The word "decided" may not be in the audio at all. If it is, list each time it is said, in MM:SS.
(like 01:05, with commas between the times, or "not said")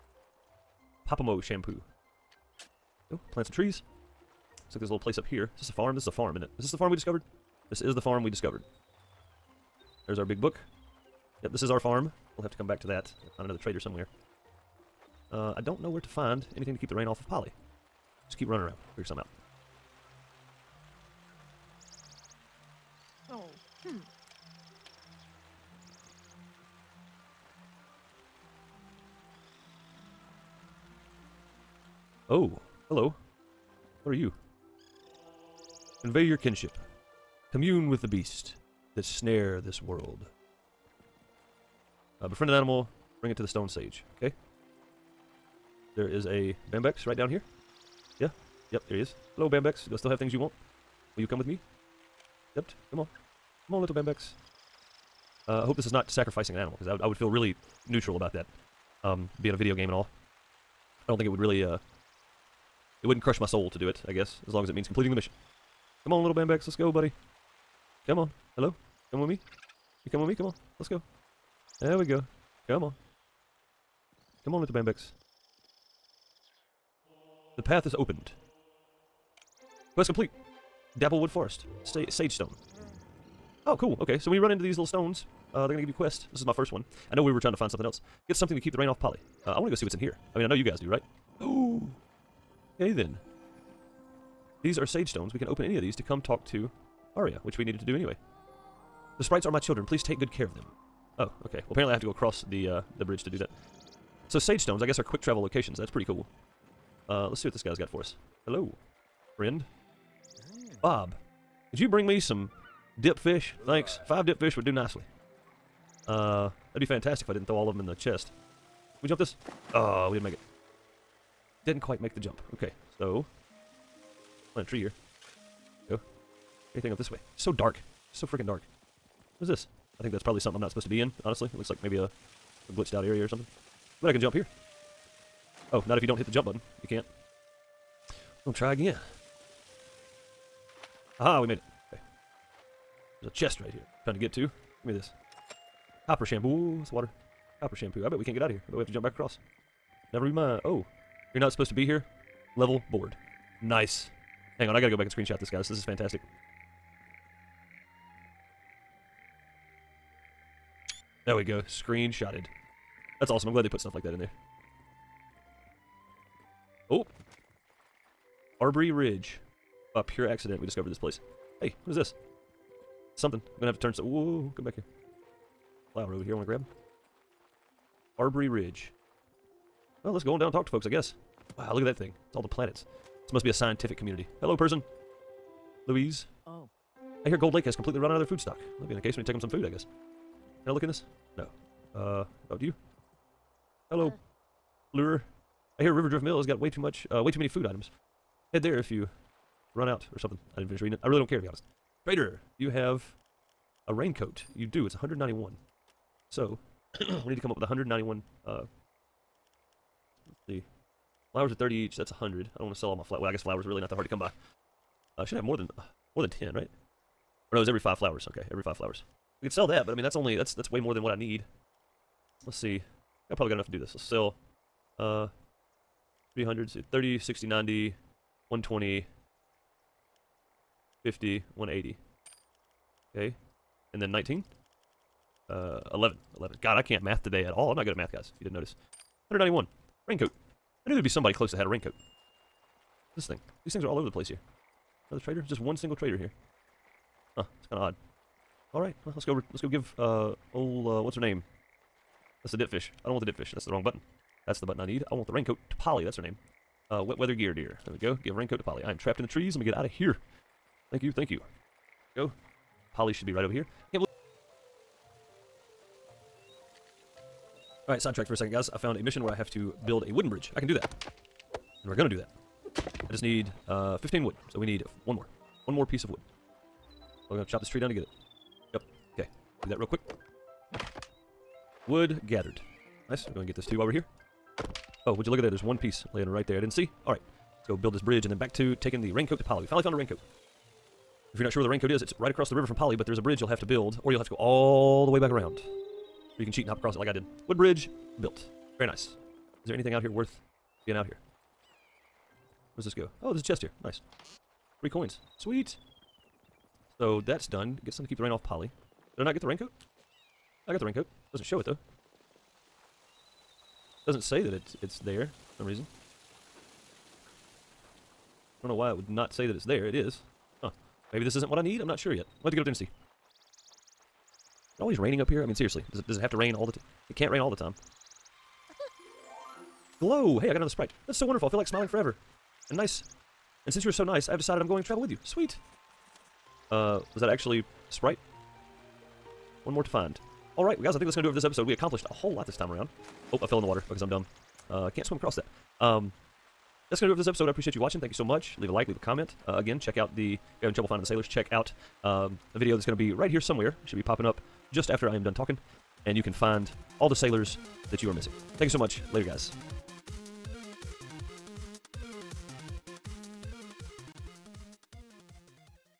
05:34.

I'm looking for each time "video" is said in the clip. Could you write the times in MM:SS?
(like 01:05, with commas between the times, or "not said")
00:59, 05:52.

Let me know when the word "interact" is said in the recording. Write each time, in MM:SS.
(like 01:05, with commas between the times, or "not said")
not said.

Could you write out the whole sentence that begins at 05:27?
It can't rain all the time.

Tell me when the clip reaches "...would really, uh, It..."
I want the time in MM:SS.
01:01.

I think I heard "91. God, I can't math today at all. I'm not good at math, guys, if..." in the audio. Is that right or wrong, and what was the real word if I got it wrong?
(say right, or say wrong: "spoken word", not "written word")
wrong: "11", not "91".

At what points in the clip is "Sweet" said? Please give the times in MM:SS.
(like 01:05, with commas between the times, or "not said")
05:05, 05:35.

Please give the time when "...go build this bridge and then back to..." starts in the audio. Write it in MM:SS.
04:47.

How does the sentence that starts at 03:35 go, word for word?
I uh, should have more than more than 10, right?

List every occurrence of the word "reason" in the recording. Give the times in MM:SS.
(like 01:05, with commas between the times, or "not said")
05:15.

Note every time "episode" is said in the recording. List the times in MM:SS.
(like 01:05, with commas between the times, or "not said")
05:41, 05:47.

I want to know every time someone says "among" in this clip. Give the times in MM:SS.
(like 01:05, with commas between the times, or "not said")
not said.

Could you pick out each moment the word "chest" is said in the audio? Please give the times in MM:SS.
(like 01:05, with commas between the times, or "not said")
01:57, 02:23, 05:03.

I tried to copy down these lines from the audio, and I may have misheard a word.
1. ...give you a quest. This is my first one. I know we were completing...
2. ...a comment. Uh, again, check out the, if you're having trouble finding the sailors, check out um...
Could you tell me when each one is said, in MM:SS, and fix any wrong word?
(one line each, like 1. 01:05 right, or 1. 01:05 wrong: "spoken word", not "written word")
1. 01:25 wrong: "trying", not "completing"
2. 05:48 right.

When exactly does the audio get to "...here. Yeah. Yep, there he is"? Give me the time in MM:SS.
00:47.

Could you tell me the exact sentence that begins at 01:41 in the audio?
Well, apparently I have to go across the uh, the bridge to do that.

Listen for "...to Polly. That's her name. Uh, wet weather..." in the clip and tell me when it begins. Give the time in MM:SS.
04:15.